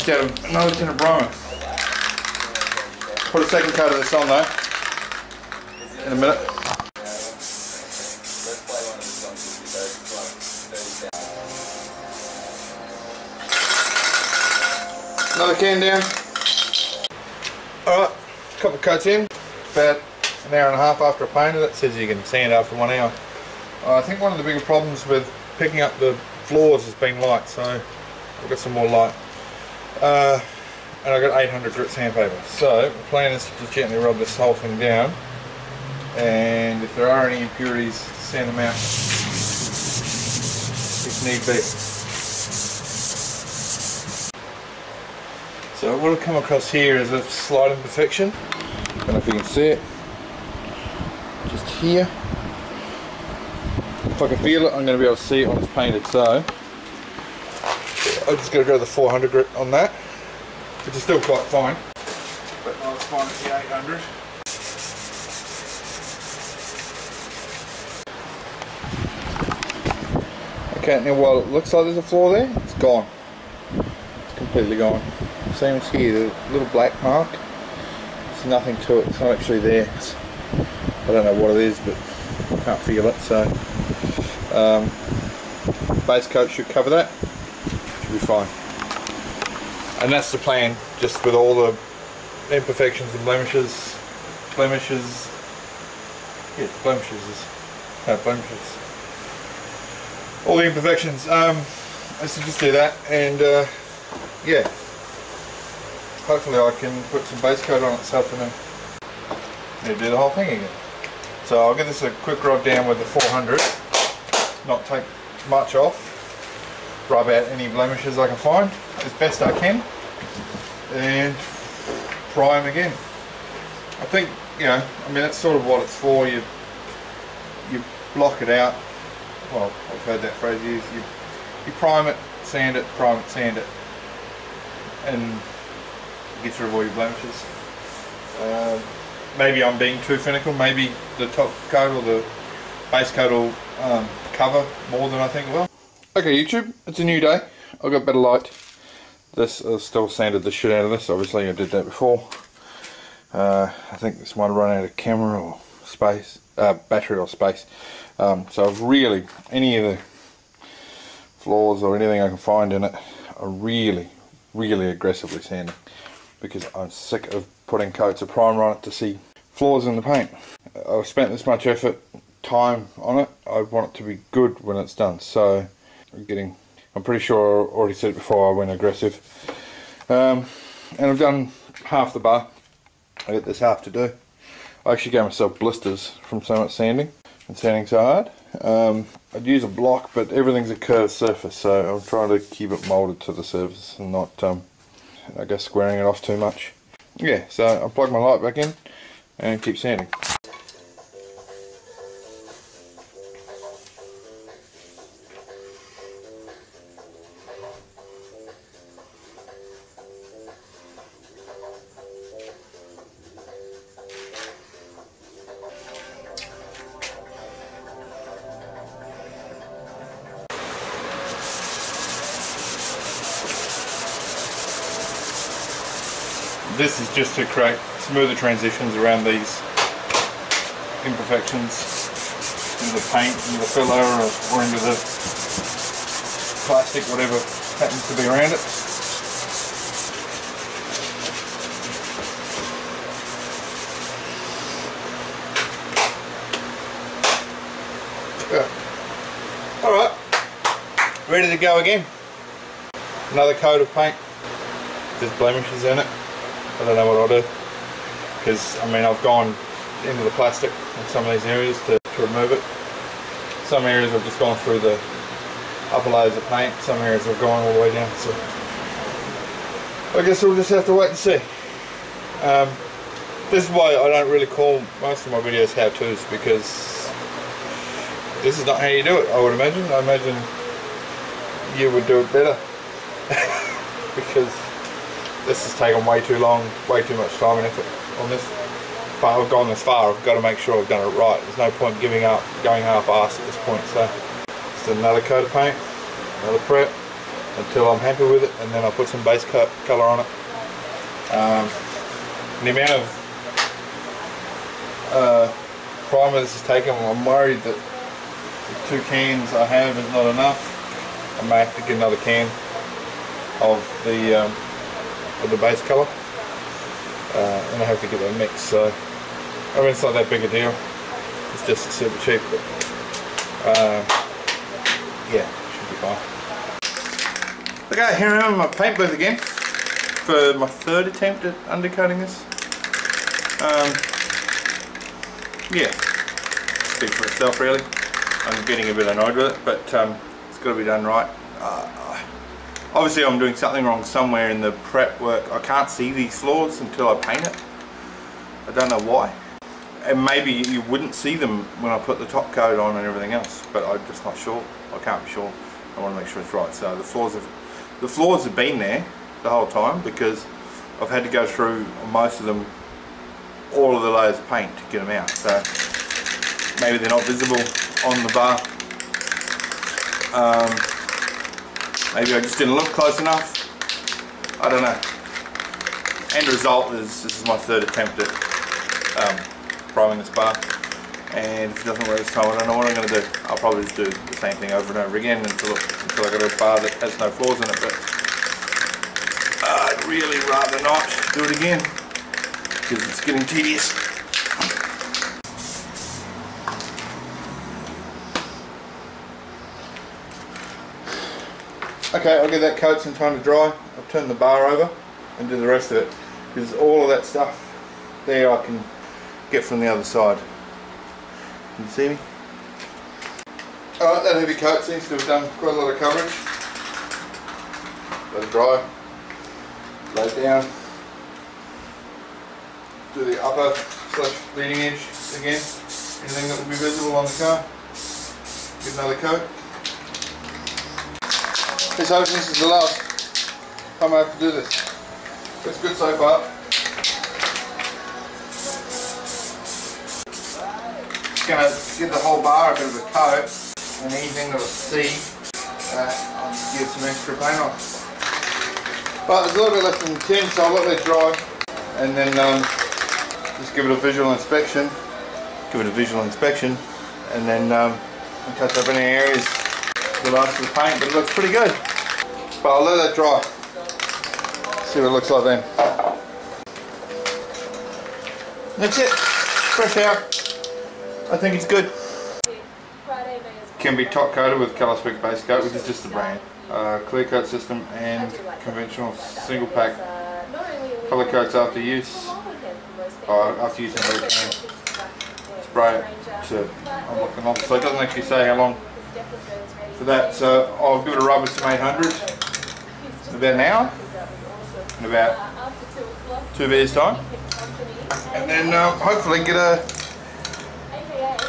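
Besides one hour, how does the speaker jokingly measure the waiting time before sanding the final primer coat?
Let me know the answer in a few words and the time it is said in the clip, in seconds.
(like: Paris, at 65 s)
two beers, at 496 s.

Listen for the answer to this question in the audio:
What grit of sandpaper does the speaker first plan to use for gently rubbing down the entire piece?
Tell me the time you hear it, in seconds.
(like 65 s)
31 s.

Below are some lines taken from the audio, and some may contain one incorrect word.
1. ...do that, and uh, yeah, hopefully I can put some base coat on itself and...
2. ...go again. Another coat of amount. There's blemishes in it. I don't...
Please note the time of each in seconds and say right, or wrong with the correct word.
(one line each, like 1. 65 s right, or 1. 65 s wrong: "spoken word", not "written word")
1. 102 s right
2. 251 s wrong: "paint", not "amount".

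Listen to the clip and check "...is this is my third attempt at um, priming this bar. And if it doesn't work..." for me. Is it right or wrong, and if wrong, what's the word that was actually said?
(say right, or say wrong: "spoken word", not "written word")
right.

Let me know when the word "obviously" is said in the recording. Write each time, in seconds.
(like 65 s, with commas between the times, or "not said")
151 s, 342 s.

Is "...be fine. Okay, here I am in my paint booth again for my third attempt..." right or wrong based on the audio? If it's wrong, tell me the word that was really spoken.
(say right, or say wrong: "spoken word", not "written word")
right.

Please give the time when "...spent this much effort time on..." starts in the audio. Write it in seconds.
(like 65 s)
171 s.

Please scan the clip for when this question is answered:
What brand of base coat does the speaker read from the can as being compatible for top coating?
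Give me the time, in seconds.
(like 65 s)
474 s.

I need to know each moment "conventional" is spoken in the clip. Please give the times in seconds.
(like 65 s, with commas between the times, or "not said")
478 s.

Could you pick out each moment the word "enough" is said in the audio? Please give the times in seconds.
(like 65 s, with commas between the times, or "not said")
310 s, 373 s.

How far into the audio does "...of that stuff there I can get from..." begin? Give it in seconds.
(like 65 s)
407 s.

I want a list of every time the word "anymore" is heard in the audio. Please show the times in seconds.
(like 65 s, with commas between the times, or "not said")
not said.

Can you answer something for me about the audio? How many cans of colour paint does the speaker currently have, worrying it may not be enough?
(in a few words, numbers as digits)
2.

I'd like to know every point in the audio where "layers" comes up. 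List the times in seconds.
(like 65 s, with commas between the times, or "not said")
266 s, 364 s.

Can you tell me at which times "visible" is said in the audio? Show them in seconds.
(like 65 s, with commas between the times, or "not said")
367 s, 426 s.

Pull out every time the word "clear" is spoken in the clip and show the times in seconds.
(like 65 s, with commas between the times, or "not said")
477 s.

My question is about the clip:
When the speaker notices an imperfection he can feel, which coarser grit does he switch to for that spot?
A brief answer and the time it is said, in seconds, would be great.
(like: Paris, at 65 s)
400 grit, at 58 s.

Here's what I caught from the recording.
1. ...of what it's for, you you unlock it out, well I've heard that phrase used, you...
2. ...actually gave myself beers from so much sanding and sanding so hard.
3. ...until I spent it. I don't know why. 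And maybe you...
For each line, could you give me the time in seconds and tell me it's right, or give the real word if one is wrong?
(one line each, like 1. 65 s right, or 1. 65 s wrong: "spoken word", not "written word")
1. 125 s wrong: "block", not "unlock"
2. 184 s wrong: "blisters", not "beers"
3. 346 s wrong: "paint", not "spent".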